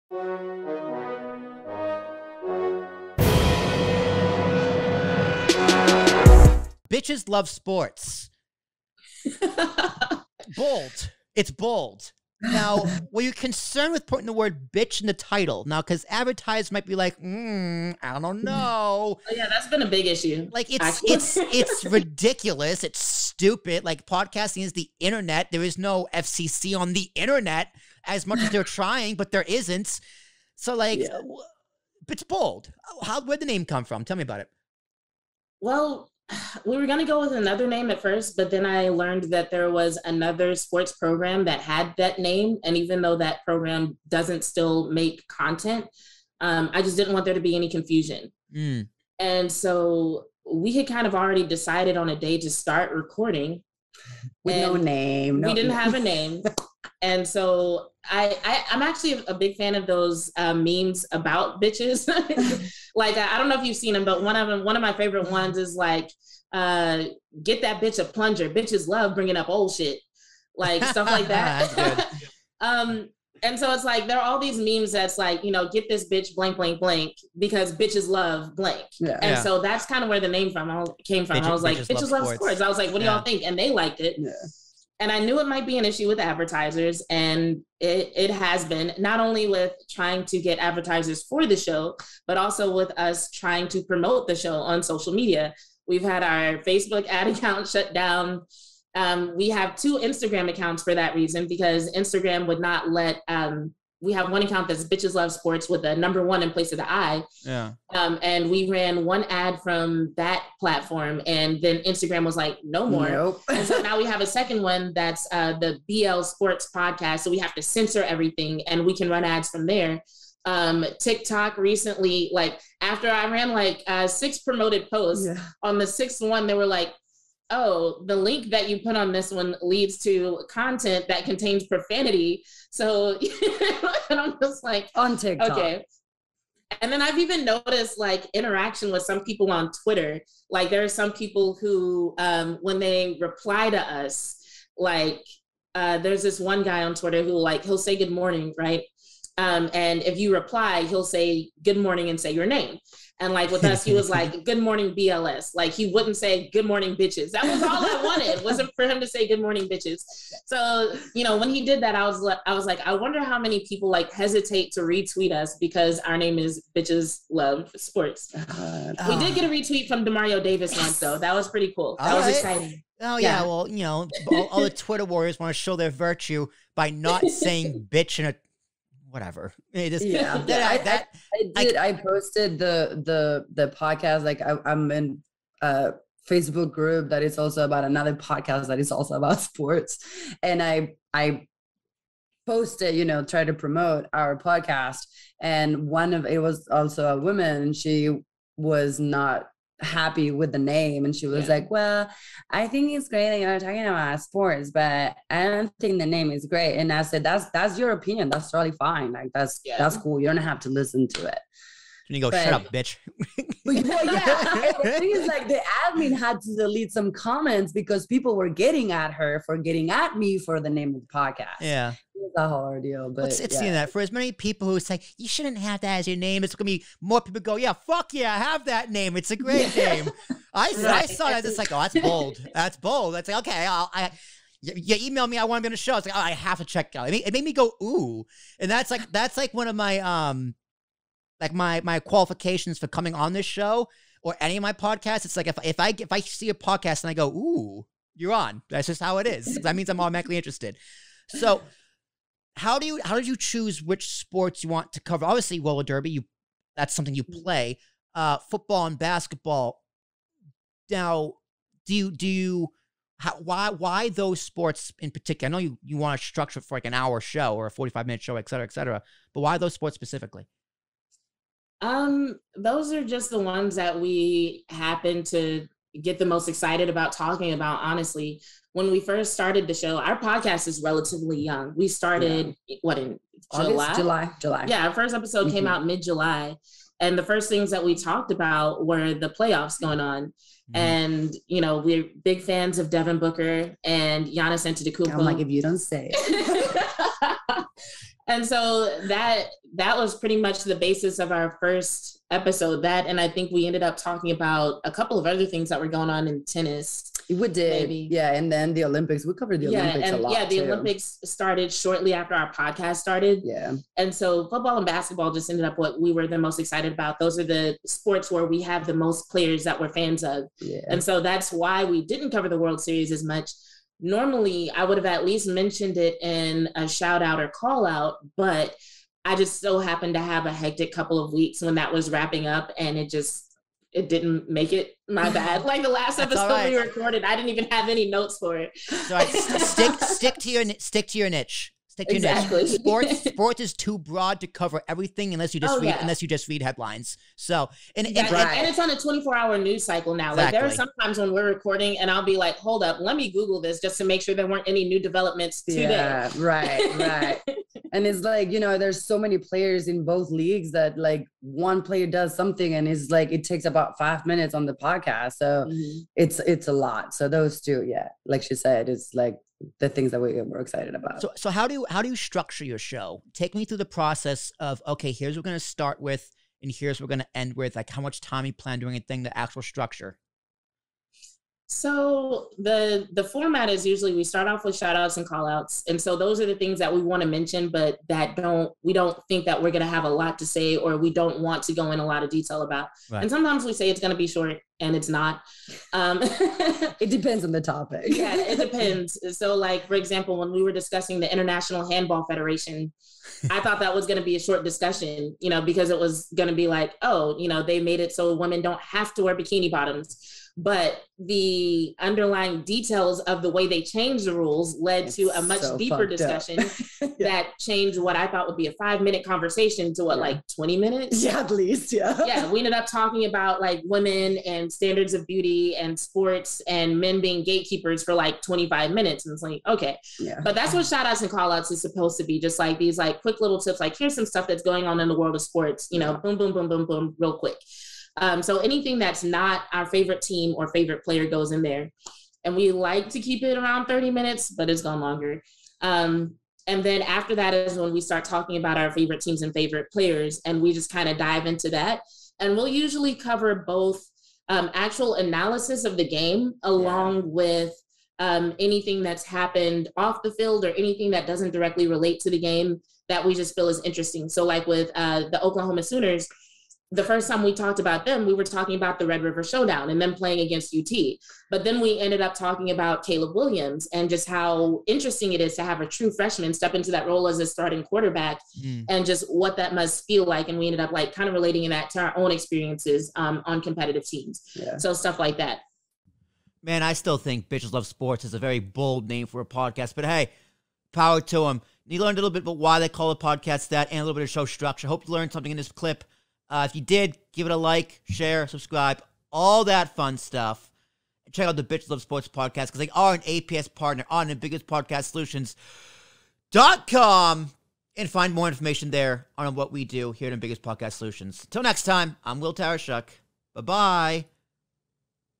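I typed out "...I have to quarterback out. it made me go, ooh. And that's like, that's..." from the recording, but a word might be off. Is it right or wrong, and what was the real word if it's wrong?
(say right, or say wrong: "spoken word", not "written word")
wrong: "check", not "quarterback".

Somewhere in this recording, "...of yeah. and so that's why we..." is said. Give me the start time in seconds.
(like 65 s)
320 s.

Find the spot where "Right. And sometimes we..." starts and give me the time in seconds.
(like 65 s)
393 s.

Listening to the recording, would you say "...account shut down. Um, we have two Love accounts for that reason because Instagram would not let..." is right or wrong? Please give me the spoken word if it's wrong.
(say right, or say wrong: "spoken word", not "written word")
wrong: "Instagram", not "Love".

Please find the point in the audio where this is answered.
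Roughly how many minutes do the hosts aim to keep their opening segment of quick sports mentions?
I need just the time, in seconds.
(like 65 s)
443 s.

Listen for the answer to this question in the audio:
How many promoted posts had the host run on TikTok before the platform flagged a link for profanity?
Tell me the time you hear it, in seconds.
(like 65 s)
124 s.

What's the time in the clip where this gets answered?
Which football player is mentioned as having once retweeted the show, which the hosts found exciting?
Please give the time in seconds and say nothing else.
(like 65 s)
170 s.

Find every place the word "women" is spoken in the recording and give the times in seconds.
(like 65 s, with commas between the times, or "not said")
408 s, 423 s.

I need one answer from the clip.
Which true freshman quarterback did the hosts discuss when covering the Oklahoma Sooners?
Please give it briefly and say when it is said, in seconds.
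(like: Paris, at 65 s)
Caleb Williams, at 473 s.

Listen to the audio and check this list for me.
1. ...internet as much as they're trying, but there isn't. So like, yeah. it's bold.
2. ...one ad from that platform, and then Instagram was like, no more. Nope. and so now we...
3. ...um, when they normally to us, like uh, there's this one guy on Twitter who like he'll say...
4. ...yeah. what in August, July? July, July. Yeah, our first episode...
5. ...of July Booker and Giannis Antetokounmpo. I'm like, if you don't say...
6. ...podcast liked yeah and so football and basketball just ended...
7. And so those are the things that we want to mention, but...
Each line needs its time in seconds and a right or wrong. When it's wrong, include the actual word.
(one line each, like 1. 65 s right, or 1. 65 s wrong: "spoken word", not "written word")
1. 27 s right
2. 109 s right
3. 142 s wrong: "reply", not "normally"
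4. 282 s right
5. 292 s wrong: "Devin", not "July"
6. 312 s wrong: "started", not "liked"
7. 385 s right.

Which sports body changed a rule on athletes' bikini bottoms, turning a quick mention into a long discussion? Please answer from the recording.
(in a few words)
International Handball Federation.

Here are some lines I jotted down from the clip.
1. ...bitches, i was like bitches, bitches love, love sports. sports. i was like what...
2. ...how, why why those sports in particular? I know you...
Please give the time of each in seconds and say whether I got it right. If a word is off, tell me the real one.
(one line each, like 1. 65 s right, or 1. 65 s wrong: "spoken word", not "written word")
1. 81 s right
2. 263 s right.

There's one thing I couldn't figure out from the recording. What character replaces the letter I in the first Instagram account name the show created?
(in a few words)
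number one.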